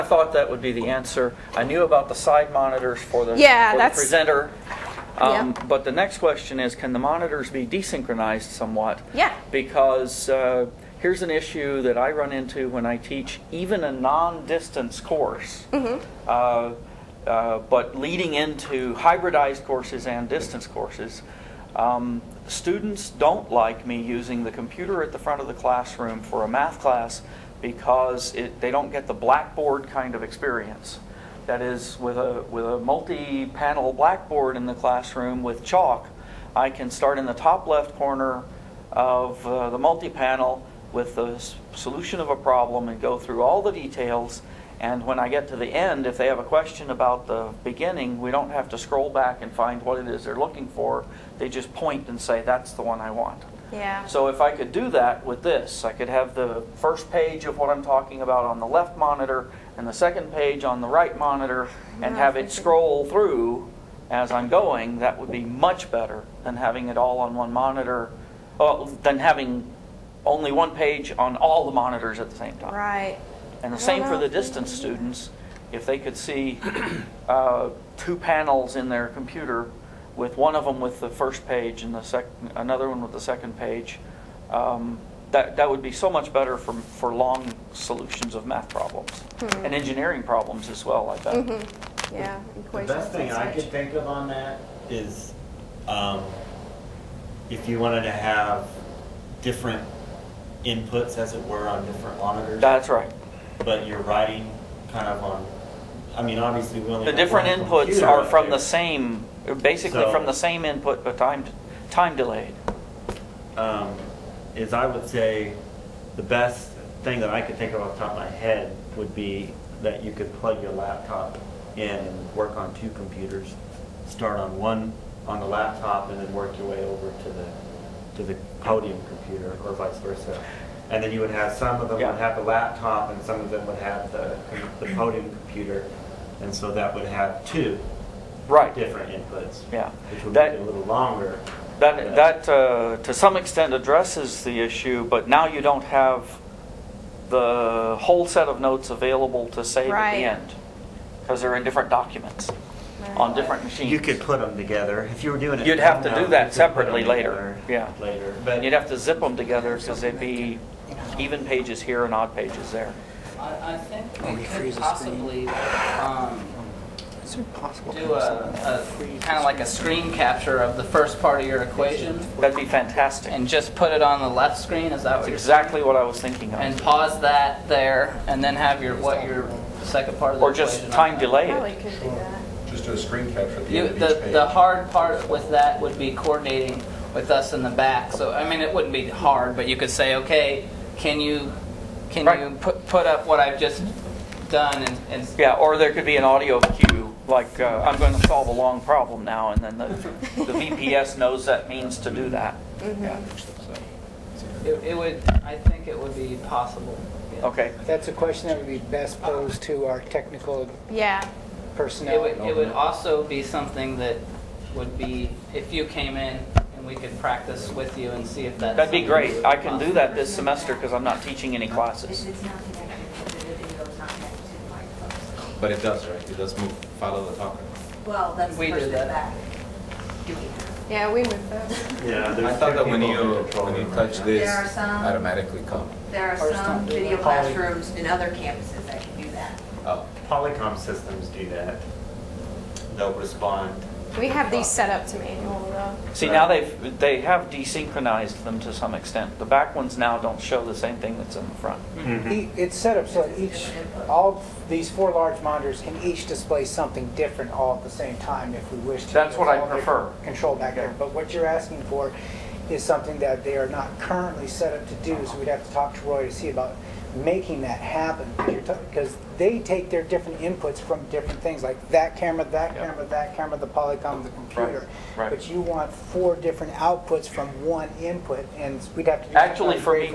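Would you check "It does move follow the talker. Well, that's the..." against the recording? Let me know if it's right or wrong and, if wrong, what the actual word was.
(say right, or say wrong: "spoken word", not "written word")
right.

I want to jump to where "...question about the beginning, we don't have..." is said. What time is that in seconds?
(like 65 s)
46 s.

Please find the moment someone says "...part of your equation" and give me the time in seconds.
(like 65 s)
171 s.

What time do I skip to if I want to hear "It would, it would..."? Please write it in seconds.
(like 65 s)
212 s.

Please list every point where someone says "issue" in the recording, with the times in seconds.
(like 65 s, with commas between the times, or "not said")
11 s, 144 s.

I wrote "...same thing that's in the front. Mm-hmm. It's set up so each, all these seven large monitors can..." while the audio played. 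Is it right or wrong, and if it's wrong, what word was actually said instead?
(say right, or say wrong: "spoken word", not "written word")
wrong: "four", not "seven".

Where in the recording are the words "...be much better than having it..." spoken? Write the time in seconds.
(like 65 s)
65 s.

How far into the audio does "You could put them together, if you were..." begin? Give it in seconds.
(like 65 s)
153 s.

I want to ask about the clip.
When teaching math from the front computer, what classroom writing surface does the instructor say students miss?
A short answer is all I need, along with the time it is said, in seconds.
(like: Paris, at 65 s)
multi-panel blackboard, at 32 s.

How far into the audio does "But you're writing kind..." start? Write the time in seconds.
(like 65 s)
103 s.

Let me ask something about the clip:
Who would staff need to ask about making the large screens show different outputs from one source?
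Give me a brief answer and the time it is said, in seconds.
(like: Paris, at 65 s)
Roy, at 266 s.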